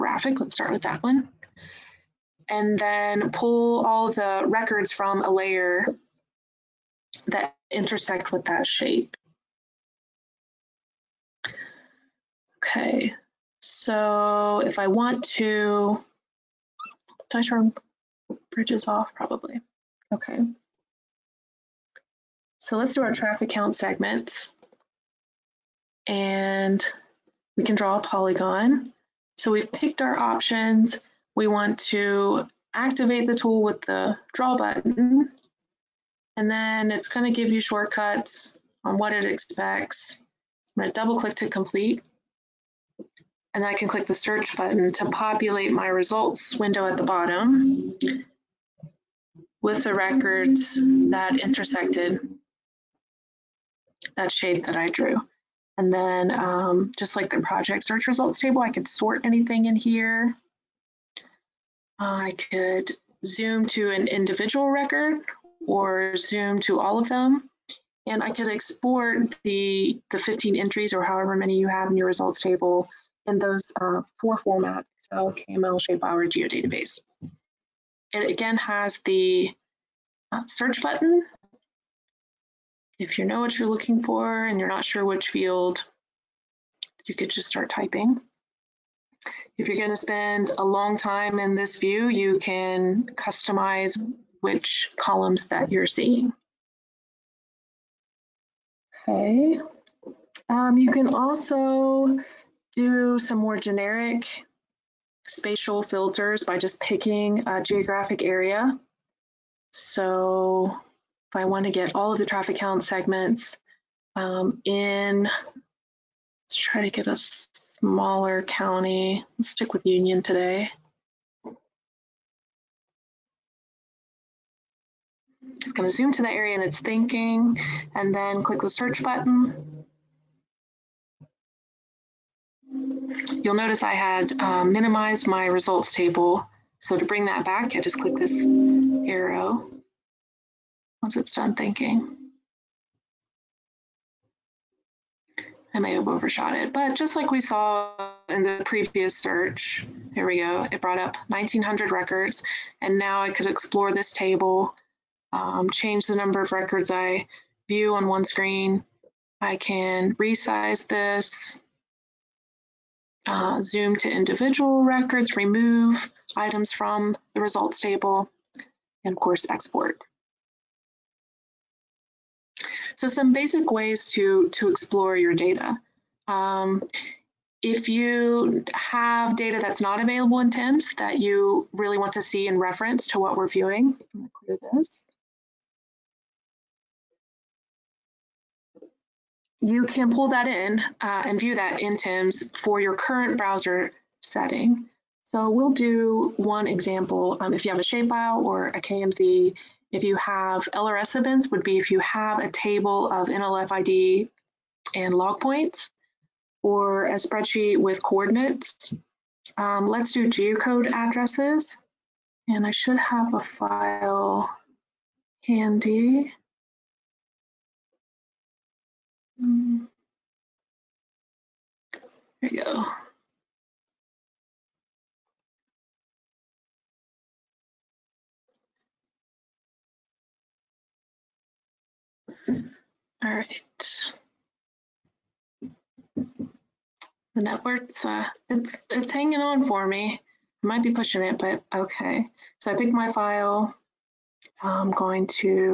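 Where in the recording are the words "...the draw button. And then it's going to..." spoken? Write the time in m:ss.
0:33.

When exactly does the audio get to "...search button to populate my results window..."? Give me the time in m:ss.
0:44.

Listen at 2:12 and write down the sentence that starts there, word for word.
You'll notice I had uh, minimized my results table.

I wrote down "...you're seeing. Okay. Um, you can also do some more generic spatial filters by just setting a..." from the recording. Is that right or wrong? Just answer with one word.
wrong.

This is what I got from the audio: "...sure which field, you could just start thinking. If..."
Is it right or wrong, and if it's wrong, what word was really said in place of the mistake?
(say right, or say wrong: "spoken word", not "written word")
wrong: "typing", not "thinking".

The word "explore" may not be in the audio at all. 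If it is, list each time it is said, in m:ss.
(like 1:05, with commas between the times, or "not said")
2:33, 2:54.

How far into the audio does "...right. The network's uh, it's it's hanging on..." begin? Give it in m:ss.
3:53.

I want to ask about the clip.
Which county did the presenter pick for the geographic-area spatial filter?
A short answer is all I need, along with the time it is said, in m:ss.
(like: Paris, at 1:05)
Union, at 1:59.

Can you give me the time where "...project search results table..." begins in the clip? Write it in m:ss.
0:57.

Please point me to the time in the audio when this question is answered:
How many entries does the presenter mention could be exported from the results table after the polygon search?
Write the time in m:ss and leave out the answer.
1:10.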